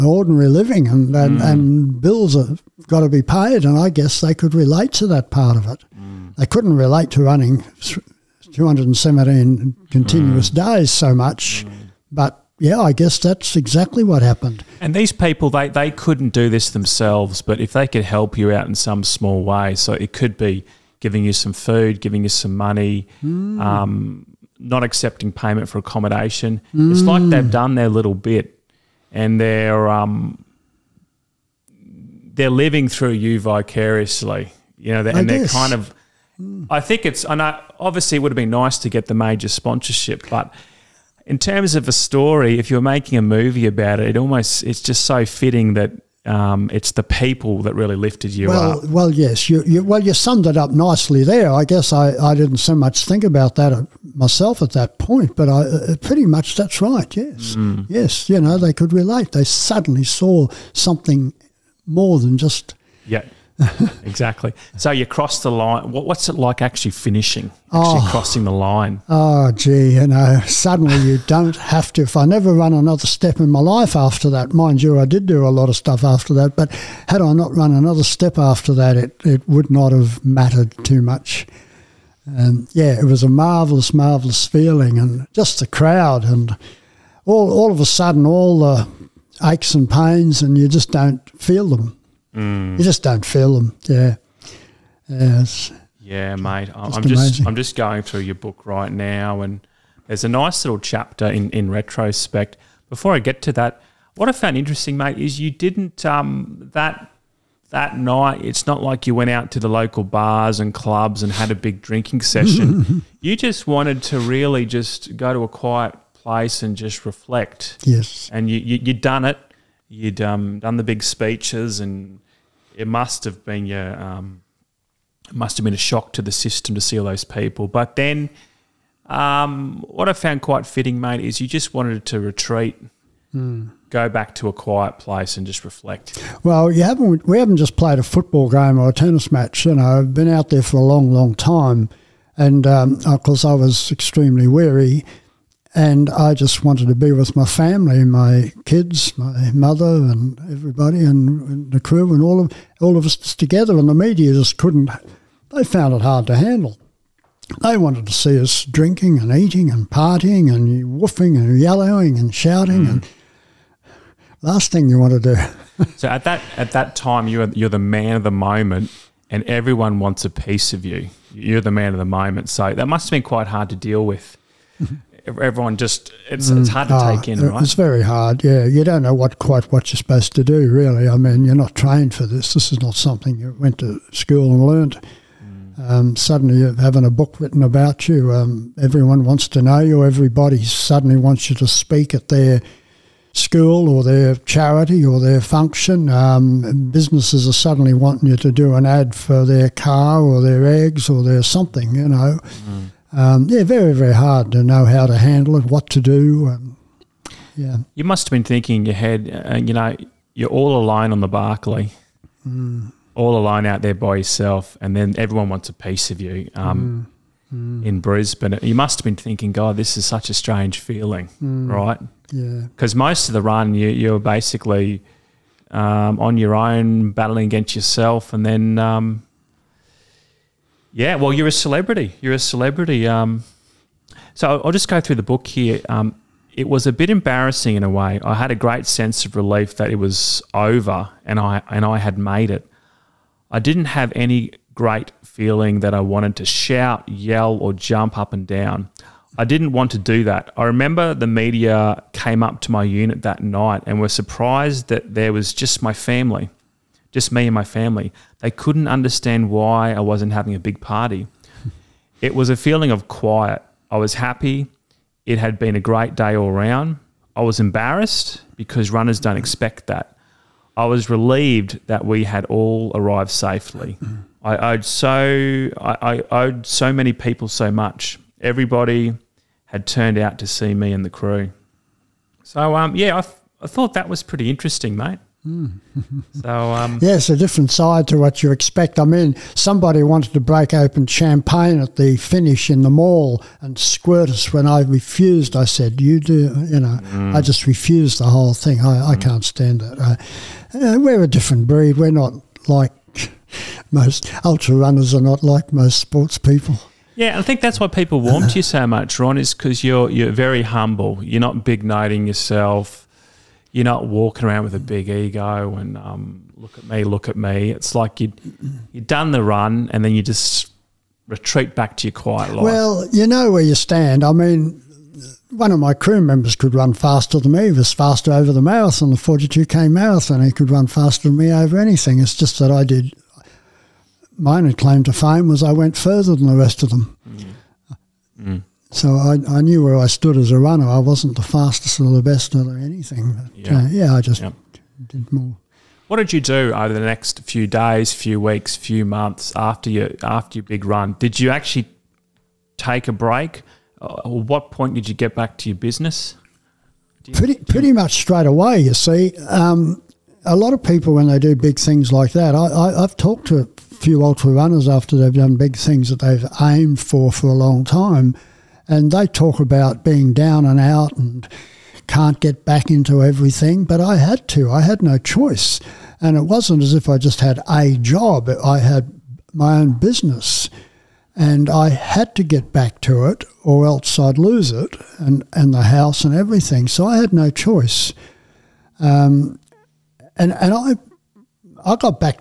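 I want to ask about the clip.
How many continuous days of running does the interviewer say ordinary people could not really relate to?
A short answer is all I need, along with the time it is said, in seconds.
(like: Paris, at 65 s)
217, at 8 s.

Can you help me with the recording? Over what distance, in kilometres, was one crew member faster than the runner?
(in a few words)
42k.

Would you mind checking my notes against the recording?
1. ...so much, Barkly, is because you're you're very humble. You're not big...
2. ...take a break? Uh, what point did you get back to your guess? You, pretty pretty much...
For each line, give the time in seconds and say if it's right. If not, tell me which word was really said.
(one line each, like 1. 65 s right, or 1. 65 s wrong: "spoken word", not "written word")
1. 308 s wrong: "Ron", not "Barkly"
2. 352 s wrong: "business", not "guess".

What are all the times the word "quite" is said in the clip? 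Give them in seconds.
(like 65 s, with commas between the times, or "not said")
130 s, 173 s, 179 s.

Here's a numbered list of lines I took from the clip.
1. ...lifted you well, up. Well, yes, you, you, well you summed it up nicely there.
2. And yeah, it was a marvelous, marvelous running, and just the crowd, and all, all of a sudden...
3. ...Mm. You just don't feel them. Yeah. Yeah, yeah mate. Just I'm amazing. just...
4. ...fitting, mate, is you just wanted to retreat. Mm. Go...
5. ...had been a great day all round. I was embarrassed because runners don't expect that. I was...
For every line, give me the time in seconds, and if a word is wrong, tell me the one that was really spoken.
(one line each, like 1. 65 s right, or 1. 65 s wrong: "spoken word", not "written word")
1. 47 s right
2. 82 s wrong: "feeling", not "running"
3. 92 s right
4. 130 s right
5. 265 s right.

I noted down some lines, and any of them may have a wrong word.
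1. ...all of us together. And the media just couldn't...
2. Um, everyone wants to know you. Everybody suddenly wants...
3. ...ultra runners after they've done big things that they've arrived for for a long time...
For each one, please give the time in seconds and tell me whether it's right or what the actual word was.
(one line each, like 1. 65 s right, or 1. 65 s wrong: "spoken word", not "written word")
1. 152 s right
2. 188 s right
3. 364 s wrong: "aimed", not "arrived".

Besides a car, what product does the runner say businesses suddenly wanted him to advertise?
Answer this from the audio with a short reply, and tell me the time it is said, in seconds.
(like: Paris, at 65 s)
Eggs, at 200 s.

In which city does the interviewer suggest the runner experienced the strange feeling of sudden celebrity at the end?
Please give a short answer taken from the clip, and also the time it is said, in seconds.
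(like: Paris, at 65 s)
Brisbane, at 217 s.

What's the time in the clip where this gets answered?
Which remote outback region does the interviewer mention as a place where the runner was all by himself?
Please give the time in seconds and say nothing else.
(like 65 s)
211 s.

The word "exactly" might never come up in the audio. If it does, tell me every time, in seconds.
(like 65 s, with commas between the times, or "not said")
13 s, 64 s.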